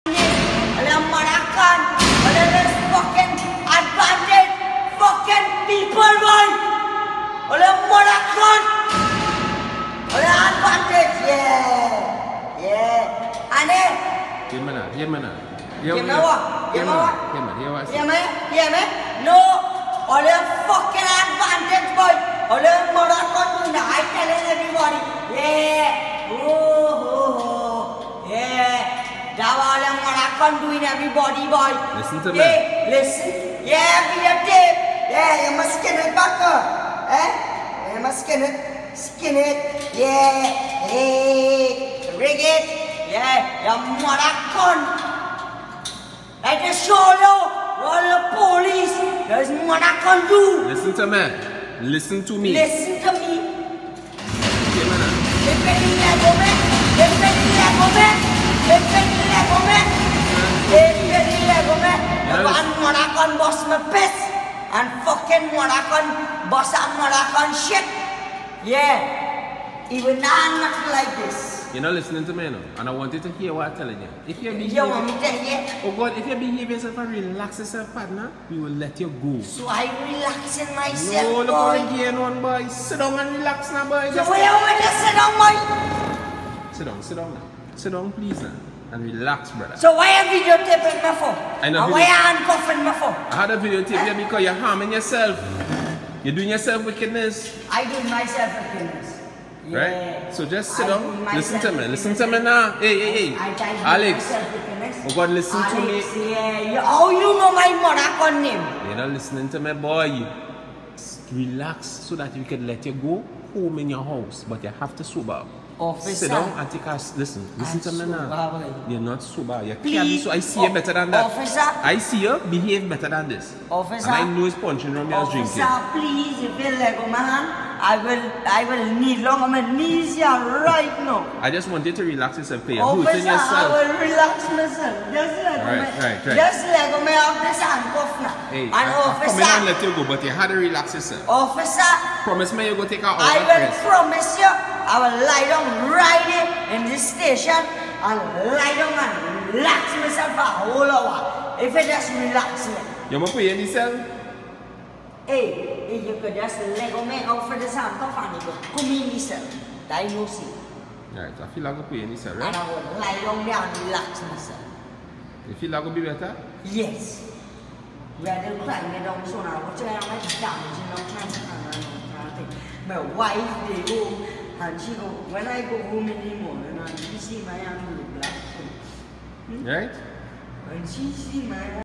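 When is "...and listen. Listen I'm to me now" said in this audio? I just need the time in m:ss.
1:56.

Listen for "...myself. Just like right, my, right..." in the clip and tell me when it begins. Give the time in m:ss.
2:14.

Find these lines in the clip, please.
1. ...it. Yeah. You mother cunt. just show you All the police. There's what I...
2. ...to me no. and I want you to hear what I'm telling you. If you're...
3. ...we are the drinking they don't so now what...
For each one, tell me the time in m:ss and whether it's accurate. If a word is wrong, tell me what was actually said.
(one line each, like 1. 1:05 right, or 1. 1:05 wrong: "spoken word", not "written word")
1. 0:42 right
2. 1:12 right
3. 2:48 wrong: "crying", not "drinking".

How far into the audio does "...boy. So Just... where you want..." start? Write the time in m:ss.
1:23.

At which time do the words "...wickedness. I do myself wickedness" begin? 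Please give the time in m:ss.
1:36.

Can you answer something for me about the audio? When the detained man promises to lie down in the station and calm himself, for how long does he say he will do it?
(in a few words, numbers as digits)
a whole hour.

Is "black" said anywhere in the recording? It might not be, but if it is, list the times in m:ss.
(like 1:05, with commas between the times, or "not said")
2:58.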